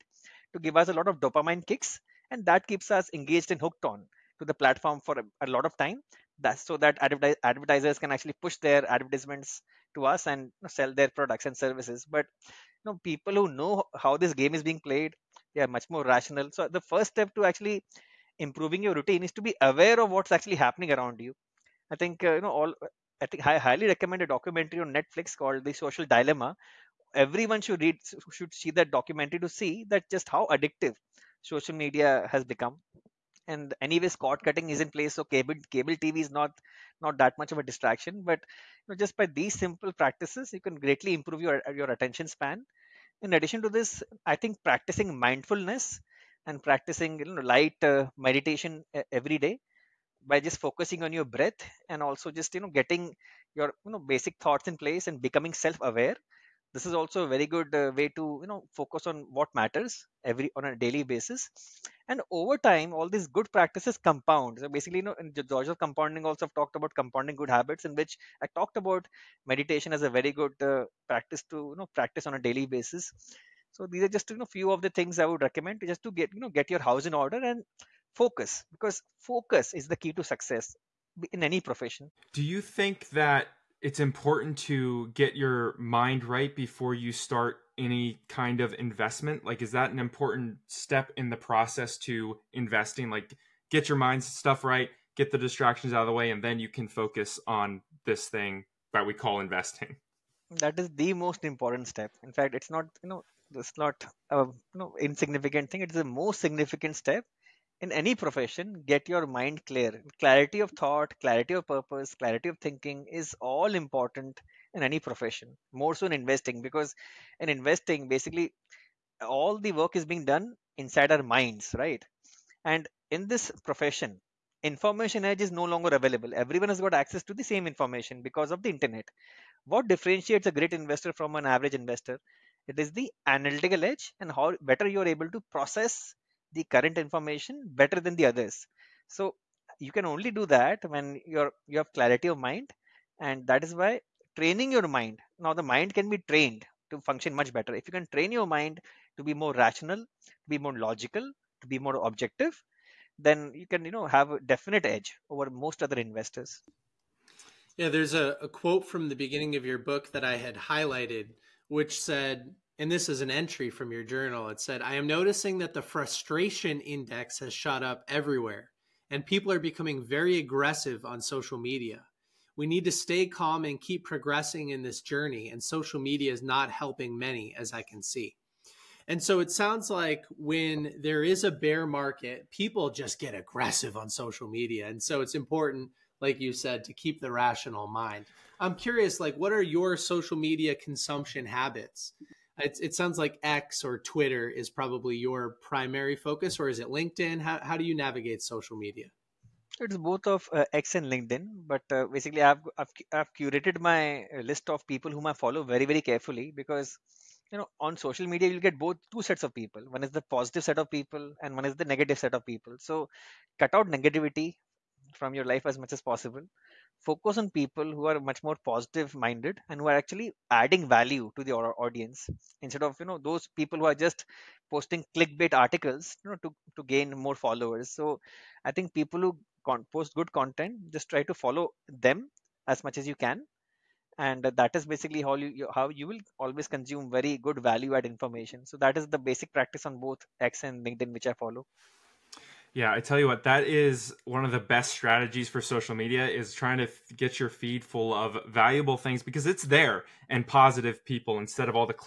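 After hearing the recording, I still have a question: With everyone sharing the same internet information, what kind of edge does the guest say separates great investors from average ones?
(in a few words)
analytical edge.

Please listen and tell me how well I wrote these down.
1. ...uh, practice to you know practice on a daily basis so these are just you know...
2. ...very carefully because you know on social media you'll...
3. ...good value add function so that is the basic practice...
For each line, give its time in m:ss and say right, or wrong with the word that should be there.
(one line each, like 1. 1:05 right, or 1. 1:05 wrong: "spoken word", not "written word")
1. 1:10 right
2. 3:25 right
3. 3:57 wrong: "information", not "function".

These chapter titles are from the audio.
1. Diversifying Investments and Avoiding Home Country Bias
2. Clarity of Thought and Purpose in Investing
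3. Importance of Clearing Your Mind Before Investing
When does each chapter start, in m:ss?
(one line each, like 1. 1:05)
1. 3:15
2. 1:50
3. 0:35.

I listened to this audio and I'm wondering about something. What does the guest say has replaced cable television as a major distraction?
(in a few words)
cord cutting.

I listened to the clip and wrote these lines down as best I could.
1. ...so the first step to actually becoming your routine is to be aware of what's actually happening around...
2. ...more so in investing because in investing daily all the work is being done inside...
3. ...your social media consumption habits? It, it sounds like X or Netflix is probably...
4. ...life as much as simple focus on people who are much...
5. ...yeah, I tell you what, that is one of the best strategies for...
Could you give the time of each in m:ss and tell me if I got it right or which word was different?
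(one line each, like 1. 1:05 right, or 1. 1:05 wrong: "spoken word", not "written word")
1. 0:16 wrong: "improving", not "becoming"
2. 1:55 wrong: "basically", not "daily"
3. 3:09 wrong: "Twitter", not "Netflix"
4. 3:35 wrong: "possible", not "simple"
5. 4:02 right.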